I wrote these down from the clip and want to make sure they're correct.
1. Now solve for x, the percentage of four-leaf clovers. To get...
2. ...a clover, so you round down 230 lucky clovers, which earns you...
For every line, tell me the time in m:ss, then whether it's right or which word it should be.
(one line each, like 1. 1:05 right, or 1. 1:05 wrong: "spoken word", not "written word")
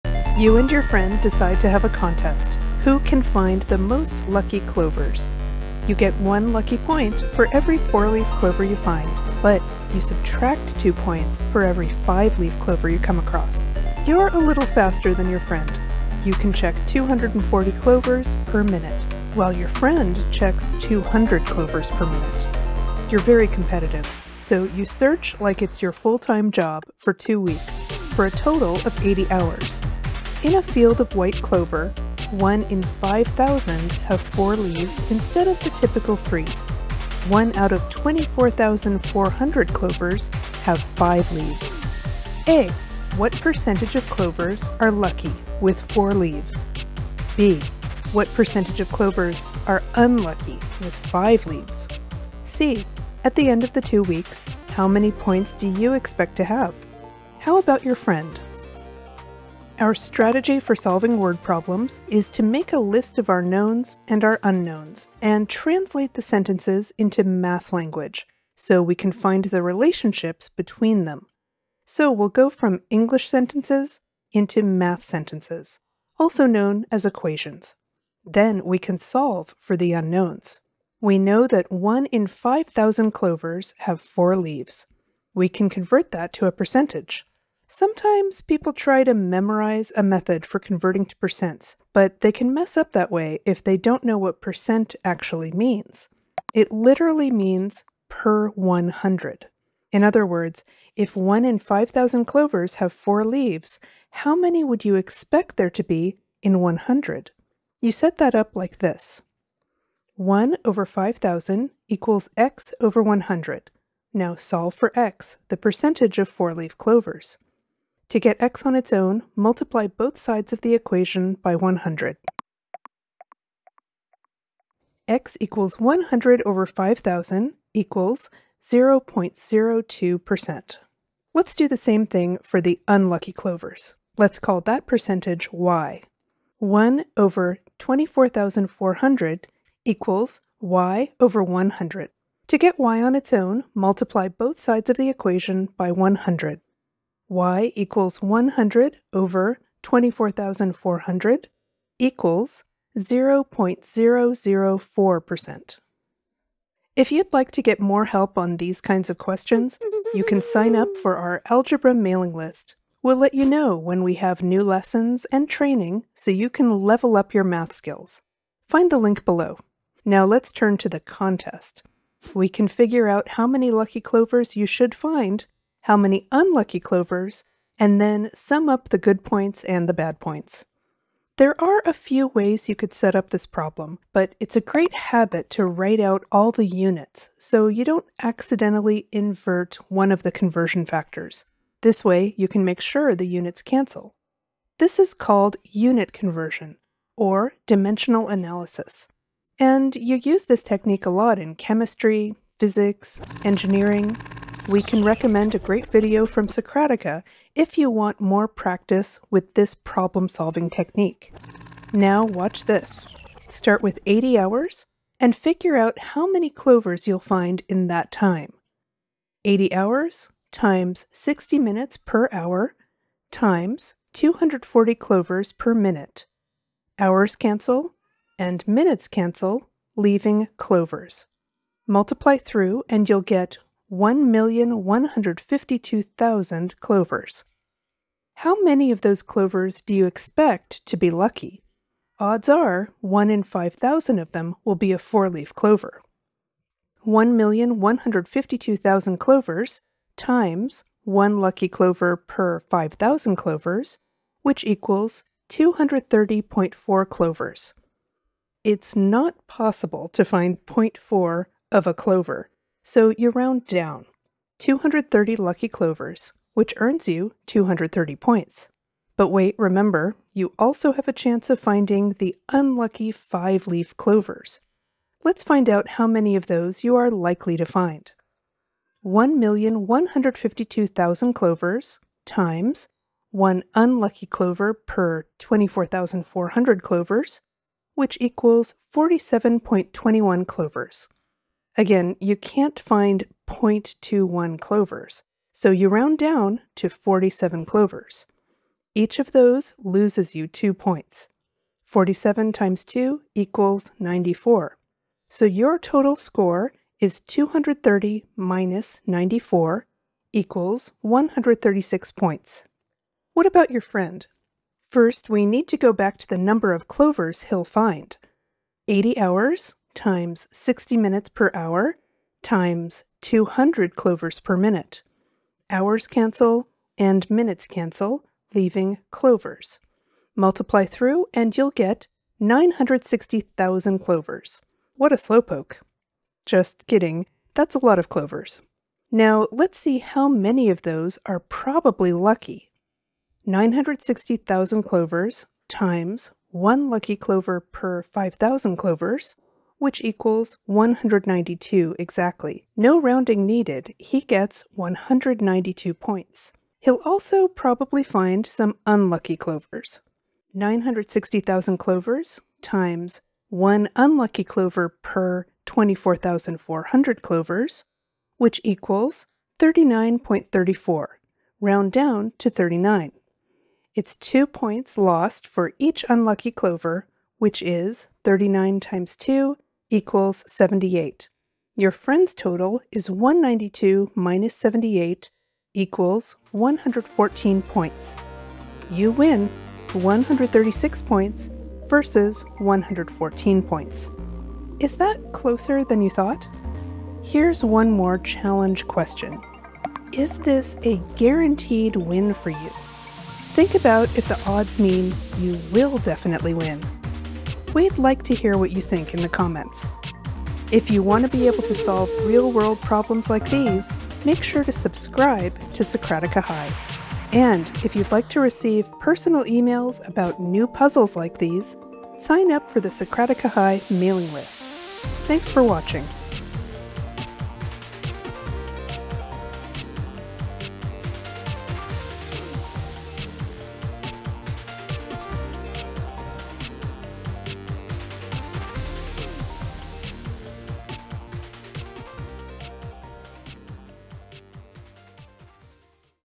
1. 1:54 right
2. 4:21 right.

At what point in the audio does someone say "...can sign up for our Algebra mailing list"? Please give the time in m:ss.
2:40.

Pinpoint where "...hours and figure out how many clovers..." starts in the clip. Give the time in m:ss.
3:34.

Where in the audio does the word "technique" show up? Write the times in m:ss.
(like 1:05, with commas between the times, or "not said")
3:20, 3:30.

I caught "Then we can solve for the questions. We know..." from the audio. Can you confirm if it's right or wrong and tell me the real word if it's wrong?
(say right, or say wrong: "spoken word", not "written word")
wrong: "unknowns", not "questions".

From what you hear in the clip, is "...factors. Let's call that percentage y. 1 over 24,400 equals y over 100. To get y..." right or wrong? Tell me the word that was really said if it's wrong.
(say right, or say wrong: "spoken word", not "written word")
wrong: "clovers", not "factors".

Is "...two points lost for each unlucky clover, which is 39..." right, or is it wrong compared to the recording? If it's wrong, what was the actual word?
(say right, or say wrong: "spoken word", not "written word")
right.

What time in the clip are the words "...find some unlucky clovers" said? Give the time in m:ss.
5:58.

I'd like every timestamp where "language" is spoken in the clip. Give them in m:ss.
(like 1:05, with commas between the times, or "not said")
1:07.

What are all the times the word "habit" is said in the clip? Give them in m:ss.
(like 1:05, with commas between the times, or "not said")
3:04.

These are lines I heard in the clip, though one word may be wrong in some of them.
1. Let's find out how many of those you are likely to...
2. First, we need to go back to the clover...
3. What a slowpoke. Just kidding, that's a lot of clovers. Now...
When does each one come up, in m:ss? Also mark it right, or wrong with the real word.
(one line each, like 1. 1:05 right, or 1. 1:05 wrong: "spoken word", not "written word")
1. 4:35 right
2. 5:14 wrong: "number", not "clover"
3. 5:34 right.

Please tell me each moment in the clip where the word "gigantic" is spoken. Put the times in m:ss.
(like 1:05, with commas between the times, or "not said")
not said.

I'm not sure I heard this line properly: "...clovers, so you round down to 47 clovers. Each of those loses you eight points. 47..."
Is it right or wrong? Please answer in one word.
wrong.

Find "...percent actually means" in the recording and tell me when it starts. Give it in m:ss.
1:34.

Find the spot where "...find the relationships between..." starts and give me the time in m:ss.
1:09.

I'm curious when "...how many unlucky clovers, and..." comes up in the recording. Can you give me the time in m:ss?
2:55.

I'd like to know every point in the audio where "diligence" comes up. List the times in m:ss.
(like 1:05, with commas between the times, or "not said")
not said.